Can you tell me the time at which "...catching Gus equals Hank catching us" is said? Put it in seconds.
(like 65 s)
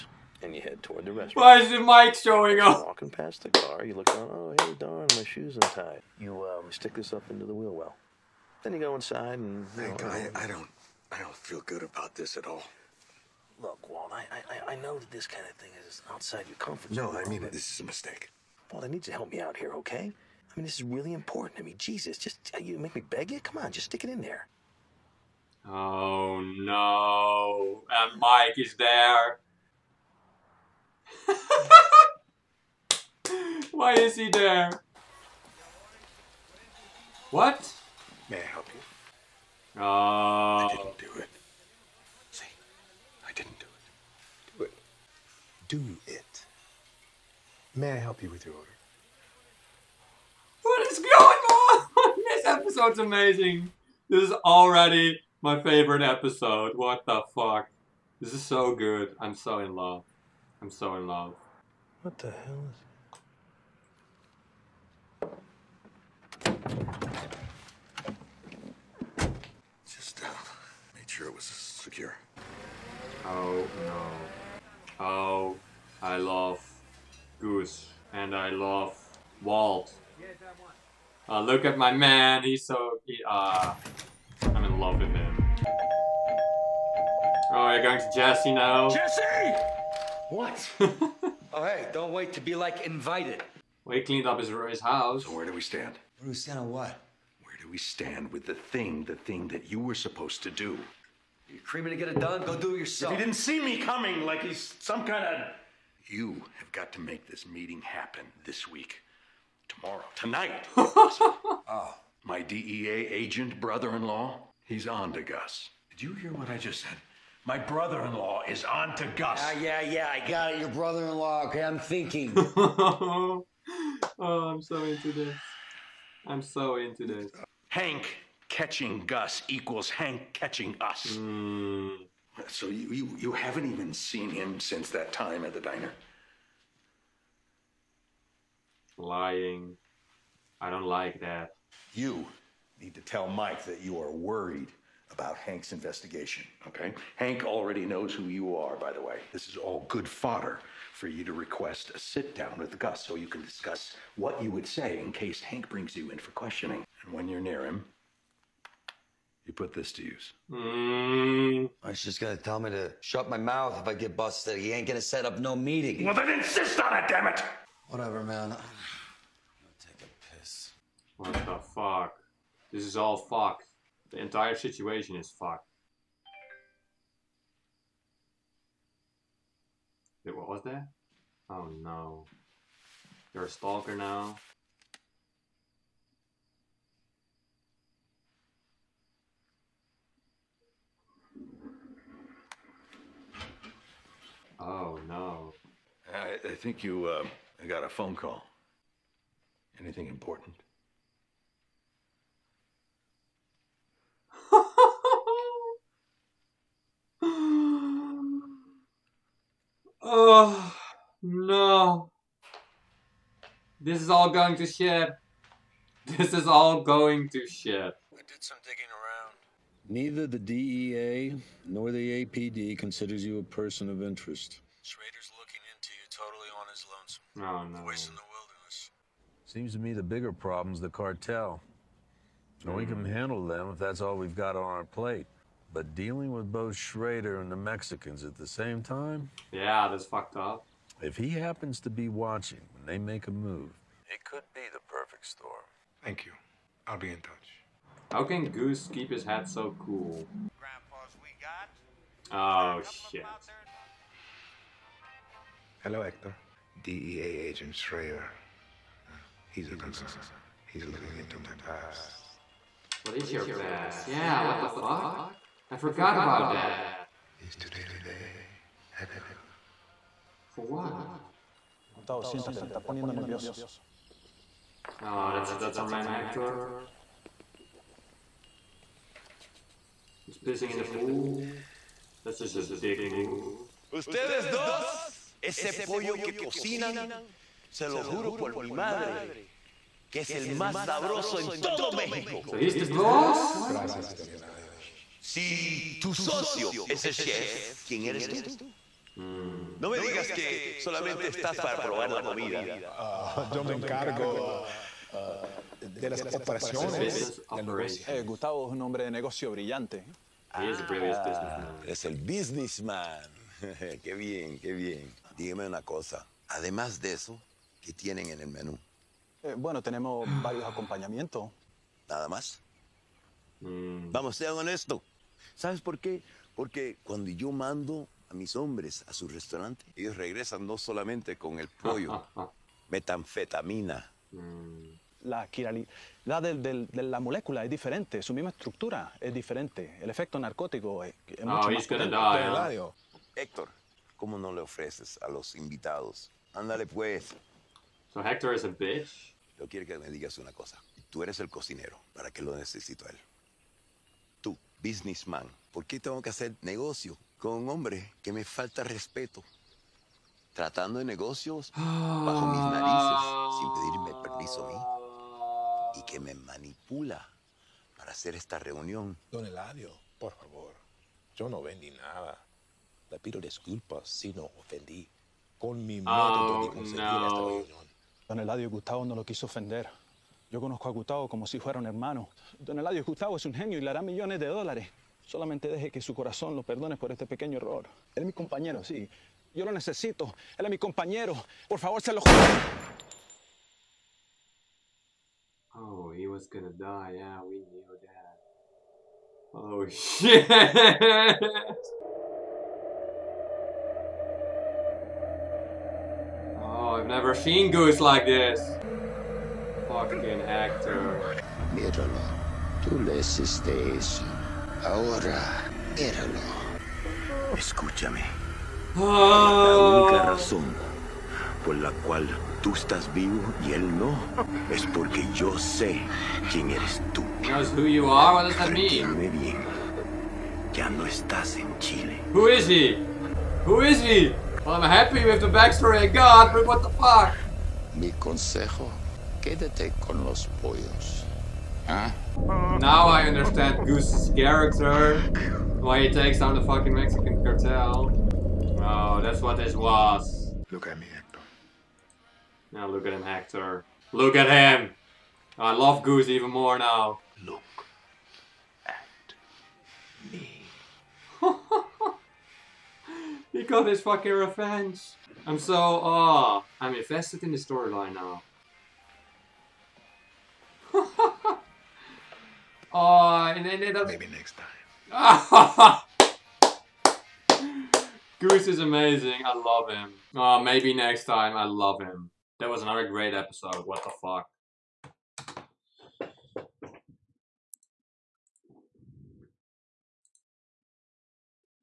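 128 s.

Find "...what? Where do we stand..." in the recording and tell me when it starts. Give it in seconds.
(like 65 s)
96 s.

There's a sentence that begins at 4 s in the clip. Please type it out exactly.
Oh, hey, darn, my shoe's untied.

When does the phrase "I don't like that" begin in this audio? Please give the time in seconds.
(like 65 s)
140 s.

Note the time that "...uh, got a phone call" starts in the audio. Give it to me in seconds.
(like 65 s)
197 s.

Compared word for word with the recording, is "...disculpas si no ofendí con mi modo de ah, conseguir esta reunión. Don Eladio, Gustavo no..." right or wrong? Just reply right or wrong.
right.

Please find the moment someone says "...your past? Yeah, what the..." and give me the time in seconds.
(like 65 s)
263 s.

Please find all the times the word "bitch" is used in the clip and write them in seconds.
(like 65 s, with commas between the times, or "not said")
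348 s.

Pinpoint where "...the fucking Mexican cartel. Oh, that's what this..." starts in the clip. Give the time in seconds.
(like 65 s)
446 s.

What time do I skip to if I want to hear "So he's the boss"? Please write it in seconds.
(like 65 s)
292 s.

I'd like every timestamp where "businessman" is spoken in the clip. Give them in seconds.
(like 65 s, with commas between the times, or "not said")
312 s, 354 s.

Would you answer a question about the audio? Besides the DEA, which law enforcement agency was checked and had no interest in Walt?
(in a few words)
APD.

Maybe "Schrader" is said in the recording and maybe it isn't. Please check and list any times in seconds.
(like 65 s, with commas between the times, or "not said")
224 s, 236 s, 257 s.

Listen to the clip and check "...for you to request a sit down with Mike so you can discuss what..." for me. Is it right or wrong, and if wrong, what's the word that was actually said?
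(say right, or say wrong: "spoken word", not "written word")
wrong: "Gus", not "Mike".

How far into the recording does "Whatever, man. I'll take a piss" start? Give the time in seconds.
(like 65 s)
167 s.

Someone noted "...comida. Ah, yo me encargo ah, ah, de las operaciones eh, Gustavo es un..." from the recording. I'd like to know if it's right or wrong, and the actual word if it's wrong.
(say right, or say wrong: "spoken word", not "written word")
right.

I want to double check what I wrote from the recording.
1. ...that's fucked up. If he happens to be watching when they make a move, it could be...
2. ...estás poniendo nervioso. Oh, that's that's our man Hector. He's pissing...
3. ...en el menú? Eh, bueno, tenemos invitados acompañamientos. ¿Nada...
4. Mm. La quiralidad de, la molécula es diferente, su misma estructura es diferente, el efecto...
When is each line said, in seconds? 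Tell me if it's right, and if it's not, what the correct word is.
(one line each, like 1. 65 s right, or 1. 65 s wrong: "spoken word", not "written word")
1. 239 s right
2. 272 s right
3. 318 s wrong: "varios", not "invitados"
4. 334 s right.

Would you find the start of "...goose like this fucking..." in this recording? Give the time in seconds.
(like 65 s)
407 s.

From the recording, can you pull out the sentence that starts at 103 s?
If he didn't see me coming like he's some kind of...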